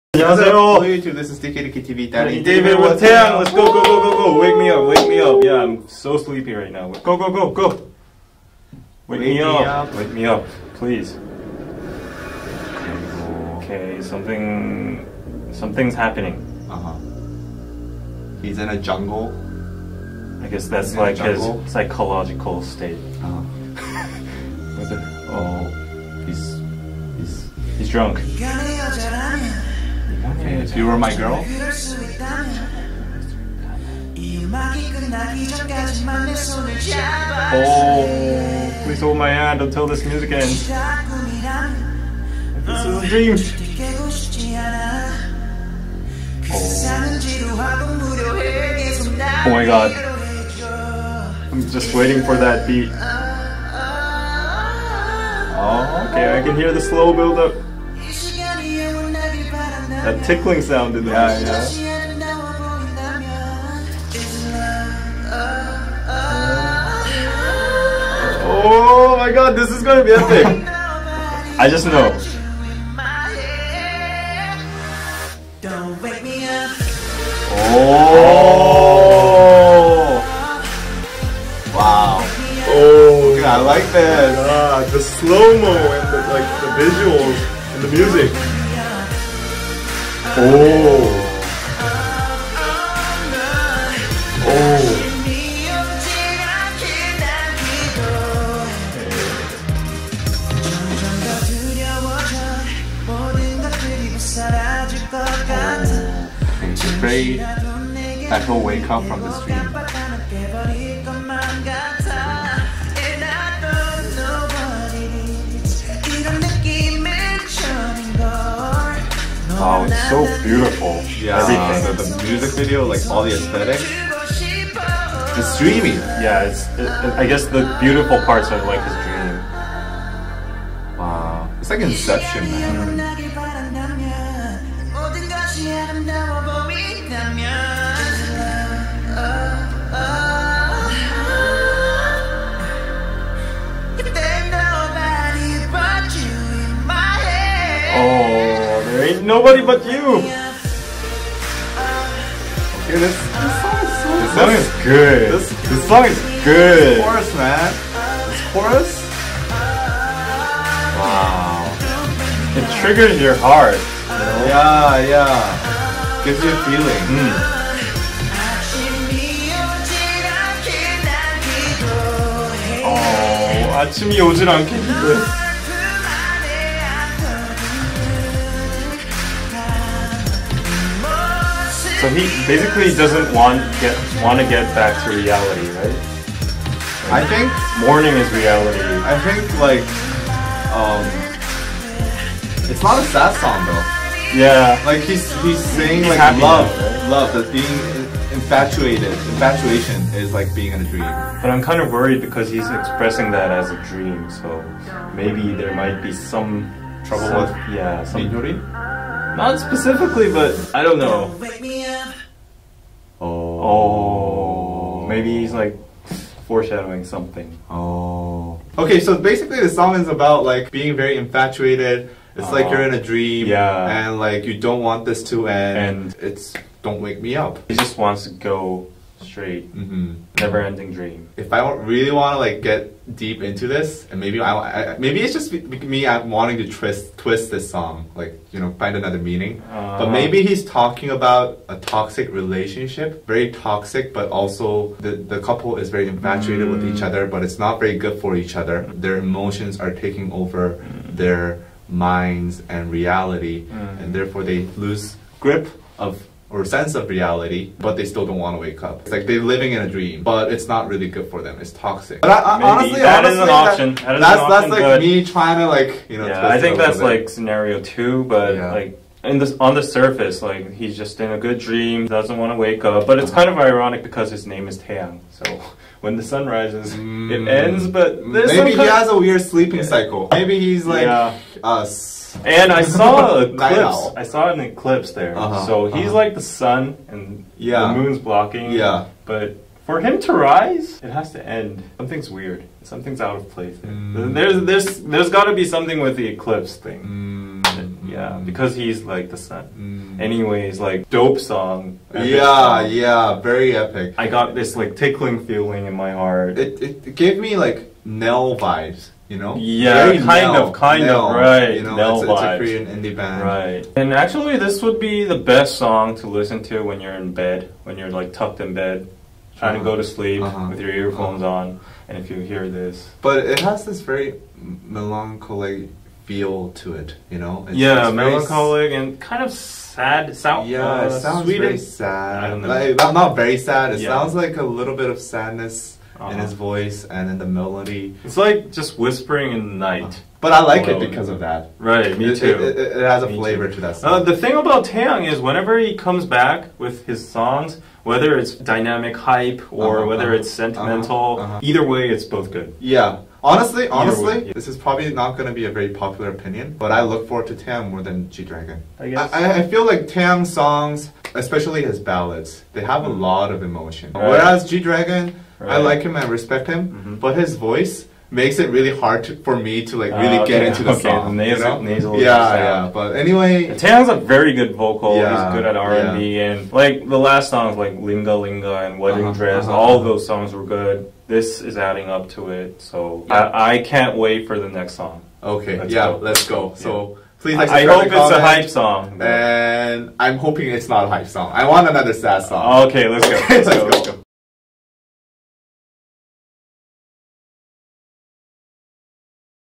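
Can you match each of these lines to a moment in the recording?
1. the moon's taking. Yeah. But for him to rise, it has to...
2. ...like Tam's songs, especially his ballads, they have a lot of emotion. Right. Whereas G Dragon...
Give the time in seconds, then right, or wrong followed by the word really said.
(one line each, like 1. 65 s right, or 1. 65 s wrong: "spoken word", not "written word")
1. 287 s wrong: "blocking", not "taking"
2. 359 s right.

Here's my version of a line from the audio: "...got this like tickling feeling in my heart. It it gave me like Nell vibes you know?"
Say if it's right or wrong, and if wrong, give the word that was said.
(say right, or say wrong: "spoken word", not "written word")
right.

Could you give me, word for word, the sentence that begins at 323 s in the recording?
But it has this very melancholic feel to it, you know?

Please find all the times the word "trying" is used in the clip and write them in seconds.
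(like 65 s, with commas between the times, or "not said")
265 s, 319 s.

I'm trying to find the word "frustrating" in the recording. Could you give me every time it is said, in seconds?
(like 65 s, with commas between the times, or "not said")
not said.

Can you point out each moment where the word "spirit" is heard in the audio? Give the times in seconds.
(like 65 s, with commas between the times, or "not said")
not said.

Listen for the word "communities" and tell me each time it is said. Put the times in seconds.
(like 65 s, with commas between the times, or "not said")
not said.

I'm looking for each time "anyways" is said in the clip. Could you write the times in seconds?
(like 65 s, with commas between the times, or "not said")
300 s, 373 s.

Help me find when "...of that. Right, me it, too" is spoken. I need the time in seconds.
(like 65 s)
341 s.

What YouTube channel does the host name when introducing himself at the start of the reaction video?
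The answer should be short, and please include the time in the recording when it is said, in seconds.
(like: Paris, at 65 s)
DKDKTV, at 1 s.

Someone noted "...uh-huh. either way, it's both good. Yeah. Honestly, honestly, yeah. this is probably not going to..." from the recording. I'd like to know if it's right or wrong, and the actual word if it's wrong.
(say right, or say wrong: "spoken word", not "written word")
right.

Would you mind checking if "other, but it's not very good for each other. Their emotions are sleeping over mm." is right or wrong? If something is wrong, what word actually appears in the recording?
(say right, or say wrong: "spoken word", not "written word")
wrong: "taking", not "sleeping".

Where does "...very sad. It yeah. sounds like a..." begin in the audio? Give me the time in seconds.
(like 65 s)
333 s.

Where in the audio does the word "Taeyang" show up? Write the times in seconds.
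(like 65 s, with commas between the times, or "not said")
274 s, 344 s, 373 s.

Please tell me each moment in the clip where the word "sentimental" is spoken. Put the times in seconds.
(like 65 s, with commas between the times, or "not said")
350 s.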